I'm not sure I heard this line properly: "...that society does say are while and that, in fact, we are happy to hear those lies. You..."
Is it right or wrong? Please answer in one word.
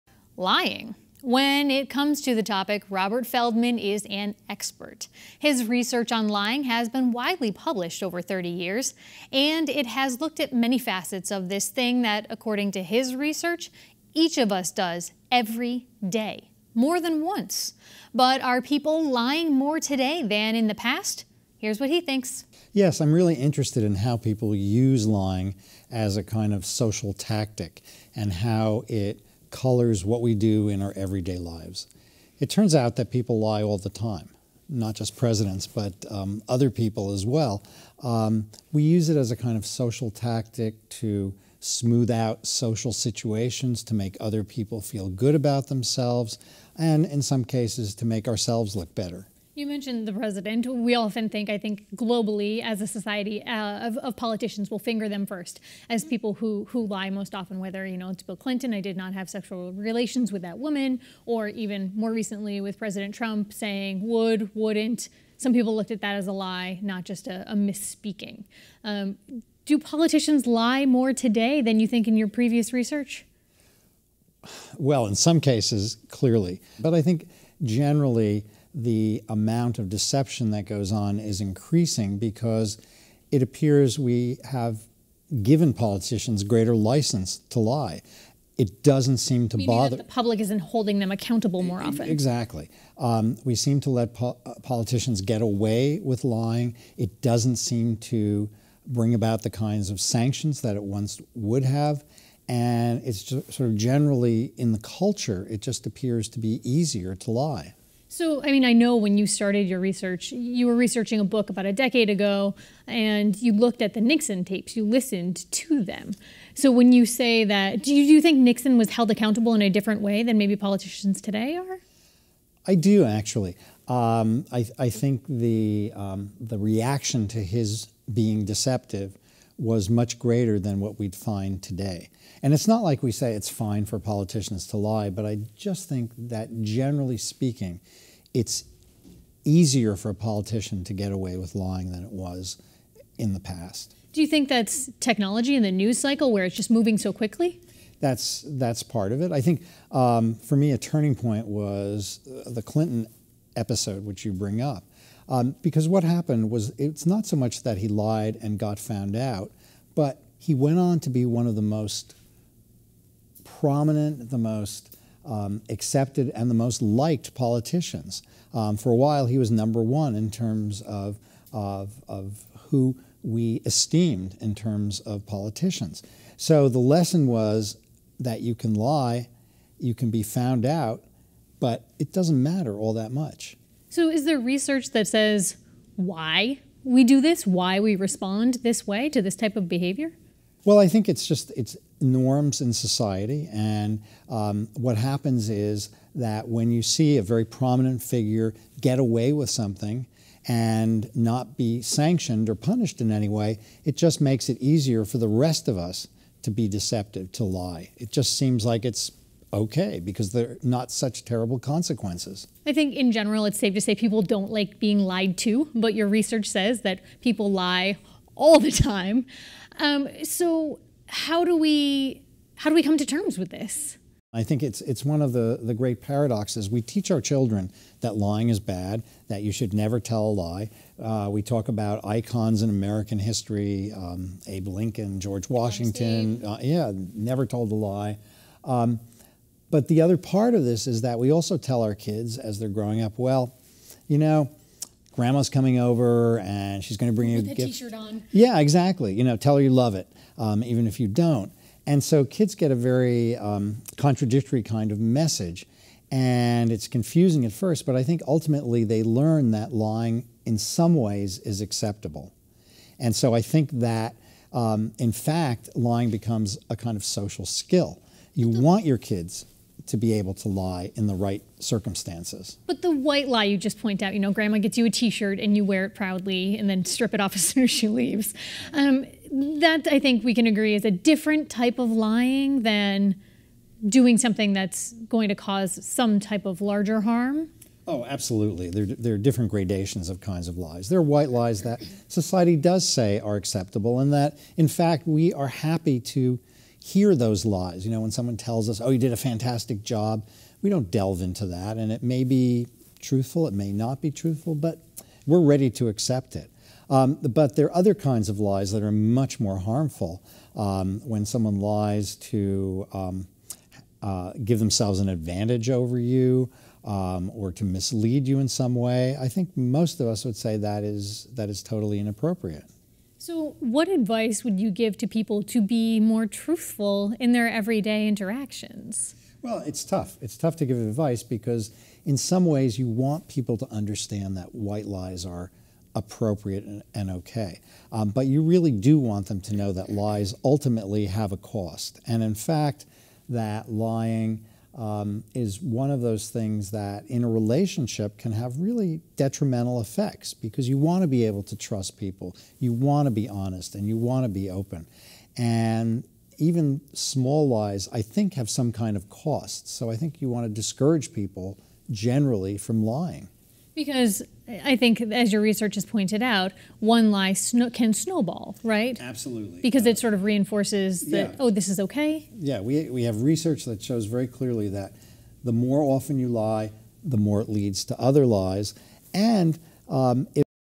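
wrong.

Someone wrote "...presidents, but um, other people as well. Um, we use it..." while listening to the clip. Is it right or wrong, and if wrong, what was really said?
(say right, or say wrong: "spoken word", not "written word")
right.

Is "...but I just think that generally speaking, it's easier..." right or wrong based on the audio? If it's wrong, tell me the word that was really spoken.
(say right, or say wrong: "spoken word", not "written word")
right.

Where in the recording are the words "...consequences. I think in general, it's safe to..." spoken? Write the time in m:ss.
3:31.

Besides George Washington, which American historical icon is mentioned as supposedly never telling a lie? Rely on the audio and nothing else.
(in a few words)
Abe Lincoln.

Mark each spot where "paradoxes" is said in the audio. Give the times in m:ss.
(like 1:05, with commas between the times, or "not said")
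3:46.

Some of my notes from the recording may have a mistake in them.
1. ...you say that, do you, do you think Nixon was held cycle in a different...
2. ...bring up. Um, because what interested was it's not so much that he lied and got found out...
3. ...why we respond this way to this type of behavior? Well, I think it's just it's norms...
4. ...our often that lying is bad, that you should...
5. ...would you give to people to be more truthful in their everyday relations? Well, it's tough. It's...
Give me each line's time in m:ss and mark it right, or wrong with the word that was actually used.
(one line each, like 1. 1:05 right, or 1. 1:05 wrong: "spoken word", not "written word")
1. 1:56 wrong: "accountable", not "cycle"
2. 2:34 wrong: "happened", not "interested"
3. 3:07 right
4. 3:47 wrong: "children", not "often"
5. 5:24 wrong: "interactions", not "relations".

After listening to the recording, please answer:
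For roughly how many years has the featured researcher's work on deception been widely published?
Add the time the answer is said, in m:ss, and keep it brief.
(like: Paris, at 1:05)
30 years, at 0:08.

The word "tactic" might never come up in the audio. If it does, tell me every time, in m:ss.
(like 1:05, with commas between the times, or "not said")
0:27, 0:40.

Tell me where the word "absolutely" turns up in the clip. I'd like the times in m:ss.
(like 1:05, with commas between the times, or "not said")
4:48, 6:08.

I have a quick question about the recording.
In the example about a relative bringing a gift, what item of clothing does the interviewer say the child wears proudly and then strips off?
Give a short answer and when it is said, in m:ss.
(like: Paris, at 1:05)
t-shirt, at 4:34.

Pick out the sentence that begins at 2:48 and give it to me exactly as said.
Um, for a while, he was number one in terms of, of, of who we esteemed in terms of politicians.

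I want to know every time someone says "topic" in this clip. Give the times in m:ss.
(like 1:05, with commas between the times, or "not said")
0:02.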